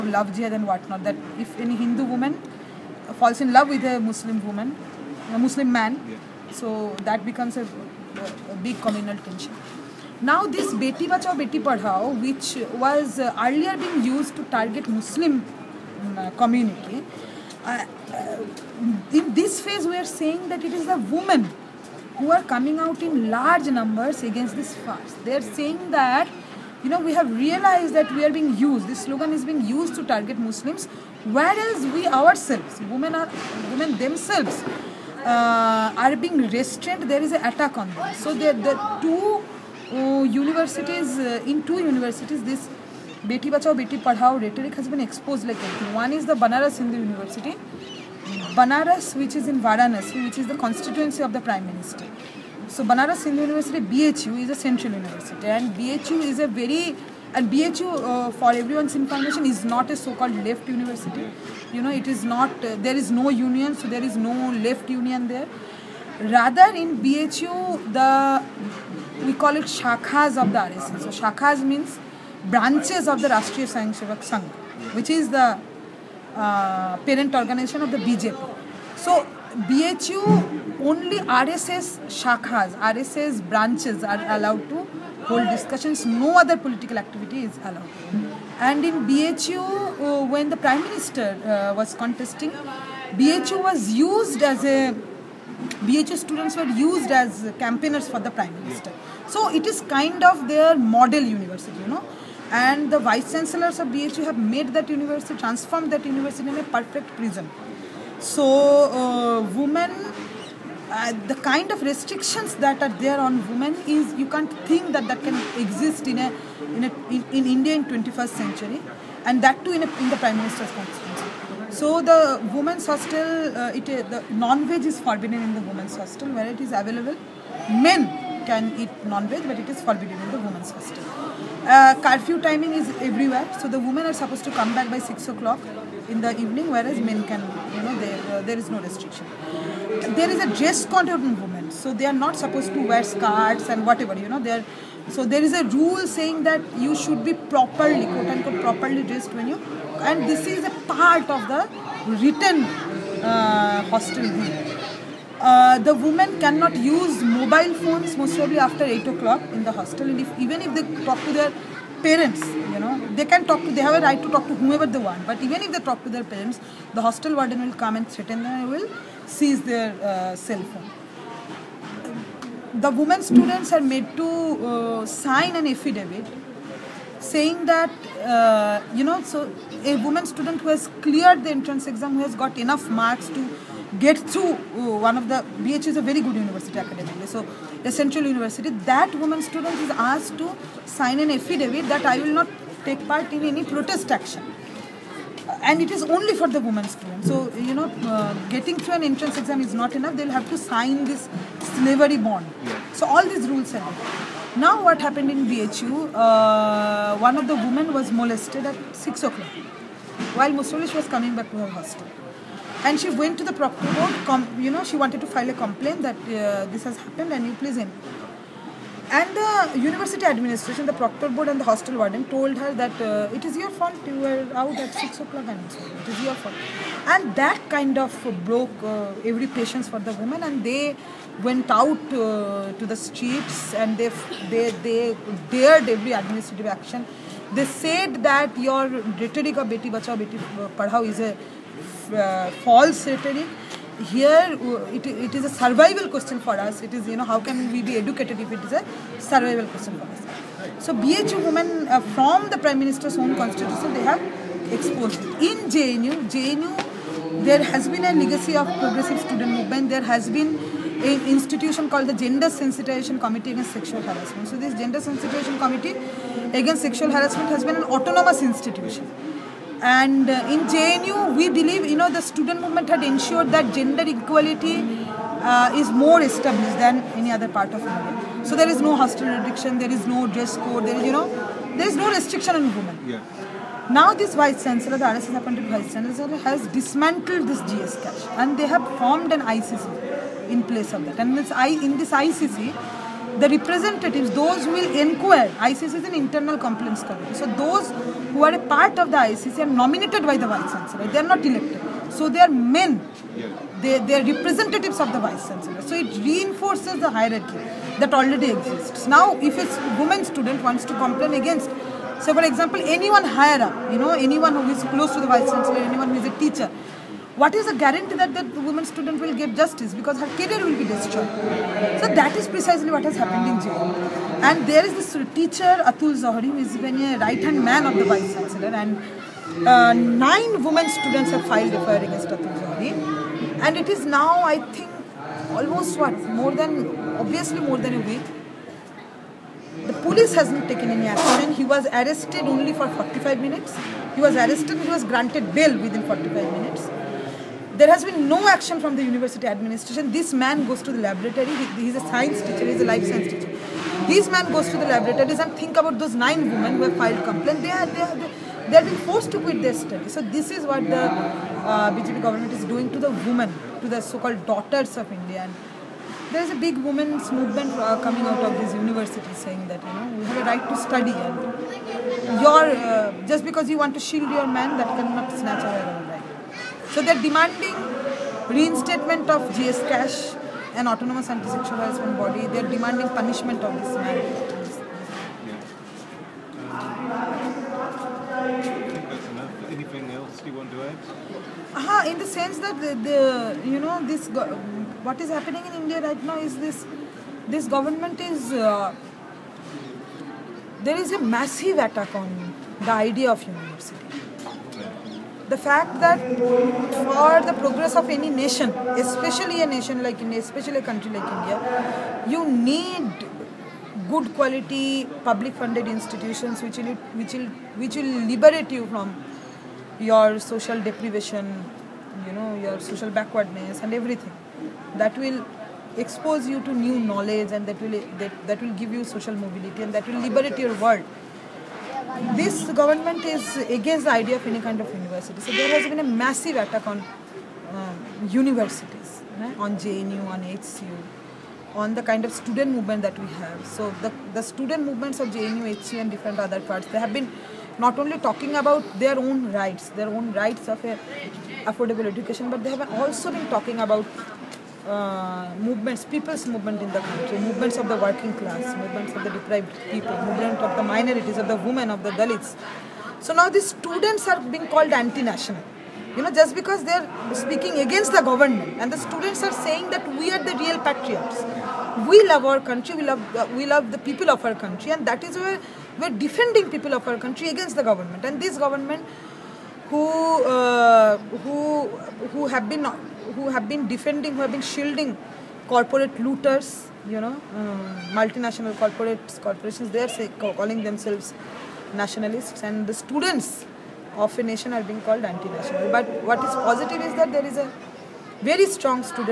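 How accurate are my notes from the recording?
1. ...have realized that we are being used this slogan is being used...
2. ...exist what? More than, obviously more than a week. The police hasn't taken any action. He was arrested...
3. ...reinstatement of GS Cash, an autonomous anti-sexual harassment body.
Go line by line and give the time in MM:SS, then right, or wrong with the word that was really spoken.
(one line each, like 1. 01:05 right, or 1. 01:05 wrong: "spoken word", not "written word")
1. 00:27 right
2. 05:35 wrong: "almost", not "exist"
3. 06:18 right.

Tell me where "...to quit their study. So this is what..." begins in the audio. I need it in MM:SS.
05:59.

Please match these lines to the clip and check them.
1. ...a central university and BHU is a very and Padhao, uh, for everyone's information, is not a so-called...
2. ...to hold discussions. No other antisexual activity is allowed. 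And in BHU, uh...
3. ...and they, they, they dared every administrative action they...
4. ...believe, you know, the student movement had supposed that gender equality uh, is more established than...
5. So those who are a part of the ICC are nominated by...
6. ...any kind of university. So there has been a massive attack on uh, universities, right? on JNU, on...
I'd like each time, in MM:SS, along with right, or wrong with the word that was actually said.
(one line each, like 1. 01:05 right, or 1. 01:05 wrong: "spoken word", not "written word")
1. 00:54 wrong: "BHU", not "Padhao"
2. 01:24 wrong: "political", not "antisexual"
3. 03:53 right
4. 04:31 wrong: "ensured", not "supposed"
5. 04:57 right
6. 07:14 right.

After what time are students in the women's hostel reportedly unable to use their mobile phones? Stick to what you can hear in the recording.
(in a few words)
8 o'clock.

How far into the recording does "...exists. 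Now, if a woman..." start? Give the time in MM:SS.
05:08.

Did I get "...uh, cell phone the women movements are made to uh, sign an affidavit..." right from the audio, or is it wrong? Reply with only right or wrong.
wrong.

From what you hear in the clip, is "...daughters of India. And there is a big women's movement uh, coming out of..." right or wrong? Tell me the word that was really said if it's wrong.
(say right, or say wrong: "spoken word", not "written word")
right.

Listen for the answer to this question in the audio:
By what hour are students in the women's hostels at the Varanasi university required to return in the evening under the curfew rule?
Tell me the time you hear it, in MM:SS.
02:14.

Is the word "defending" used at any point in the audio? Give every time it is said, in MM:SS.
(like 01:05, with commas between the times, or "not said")
07:56, 08:03.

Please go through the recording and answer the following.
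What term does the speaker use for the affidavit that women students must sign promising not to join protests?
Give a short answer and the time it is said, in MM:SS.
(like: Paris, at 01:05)
slavery bond, at 03:21.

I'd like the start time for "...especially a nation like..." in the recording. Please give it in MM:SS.
06:49.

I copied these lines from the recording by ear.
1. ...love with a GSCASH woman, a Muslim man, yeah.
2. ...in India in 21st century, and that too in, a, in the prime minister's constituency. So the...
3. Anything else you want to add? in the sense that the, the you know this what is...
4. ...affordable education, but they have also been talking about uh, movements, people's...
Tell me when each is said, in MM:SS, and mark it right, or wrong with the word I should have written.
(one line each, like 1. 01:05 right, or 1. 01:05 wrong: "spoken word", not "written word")
1. 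00:03 wrong: "Muslim", not "GSCASH"
2. 01:57 right
3. 06:29 right
4. 07:31 right.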